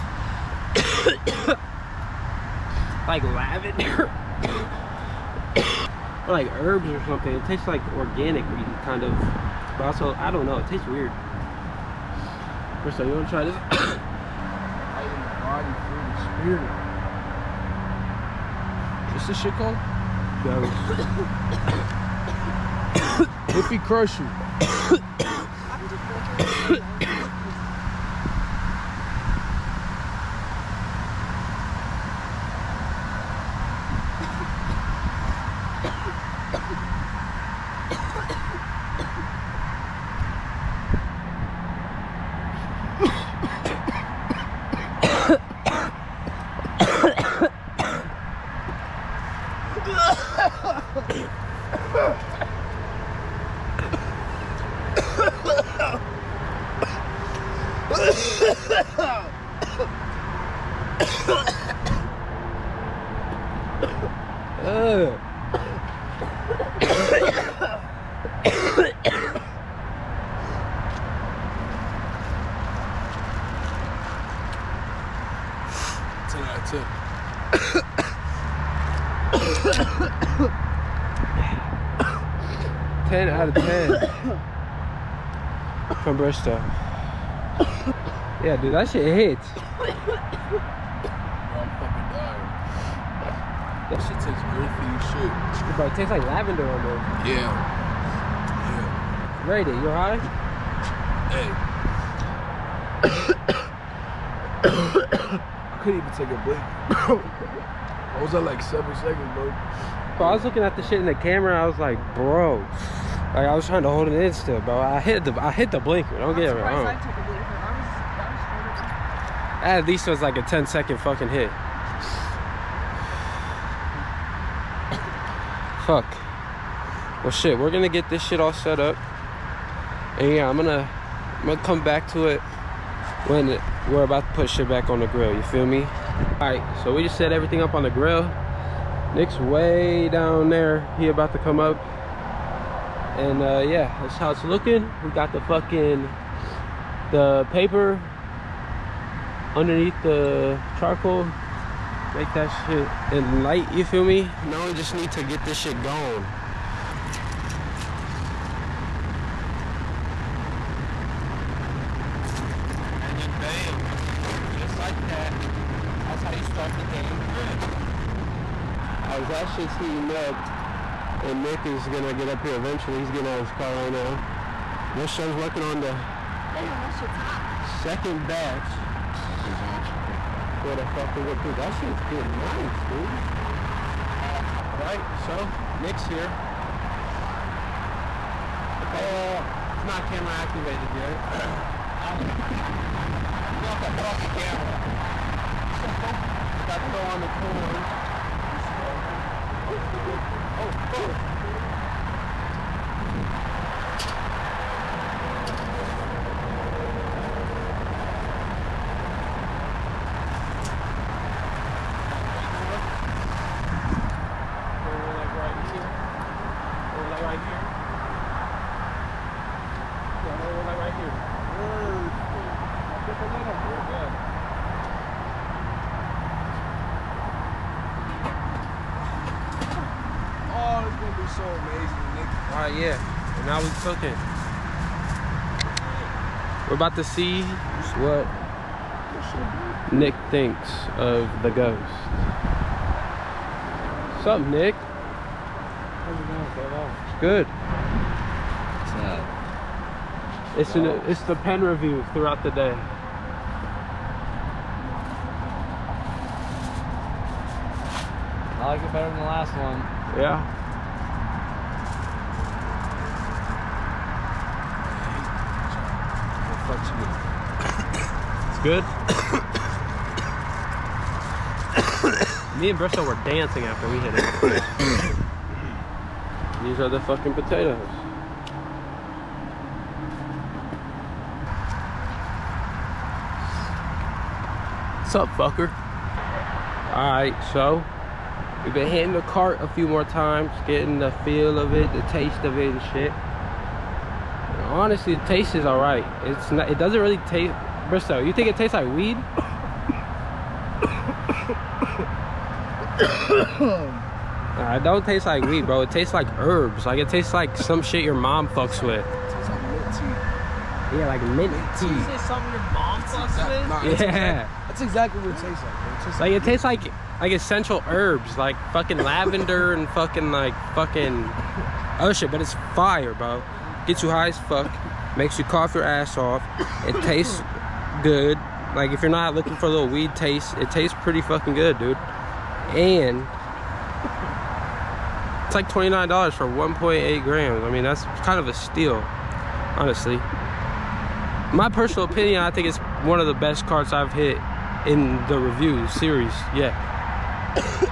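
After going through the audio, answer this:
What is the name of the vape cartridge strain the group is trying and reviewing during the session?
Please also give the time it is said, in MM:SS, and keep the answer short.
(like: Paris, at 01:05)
Hippie Crusher, at 00:23.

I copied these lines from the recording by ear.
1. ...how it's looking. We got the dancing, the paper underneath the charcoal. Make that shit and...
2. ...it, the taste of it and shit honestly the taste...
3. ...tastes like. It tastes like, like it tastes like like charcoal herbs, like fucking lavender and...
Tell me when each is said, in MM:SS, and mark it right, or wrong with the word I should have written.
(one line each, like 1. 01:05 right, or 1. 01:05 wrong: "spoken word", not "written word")
1. 02:24 wrong: "fucking", not "dancing"
2. 04:51 right
3. 05:15 wrong: "essential", not "charcoal".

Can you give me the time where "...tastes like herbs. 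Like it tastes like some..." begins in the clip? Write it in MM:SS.
05:05.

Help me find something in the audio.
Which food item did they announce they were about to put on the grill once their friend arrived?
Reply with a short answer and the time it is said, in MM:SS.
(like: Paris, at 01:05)
corn, at 03:17.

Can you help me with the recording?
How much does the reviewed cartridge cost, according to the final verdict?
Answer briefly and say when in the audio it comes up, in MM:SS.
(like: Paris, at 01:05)
$29, at 05:35.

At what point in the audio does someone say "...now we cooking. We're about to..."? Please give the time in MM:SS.
03:53.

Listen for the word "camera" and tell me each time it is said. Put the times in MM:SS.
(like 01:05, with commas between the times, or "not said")
01:51, 03:10, 03:14.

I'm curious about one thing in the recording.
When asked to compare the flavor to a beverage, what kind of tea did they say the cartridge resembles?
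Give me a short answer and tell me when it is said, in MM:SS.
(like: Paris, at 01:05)
mint tea, at 05:11.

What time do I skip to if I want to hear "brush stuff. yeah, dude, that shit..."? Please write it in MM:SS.
01:26.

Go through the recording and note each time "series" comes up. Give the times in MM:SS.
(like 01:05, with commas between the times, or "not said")
05:45.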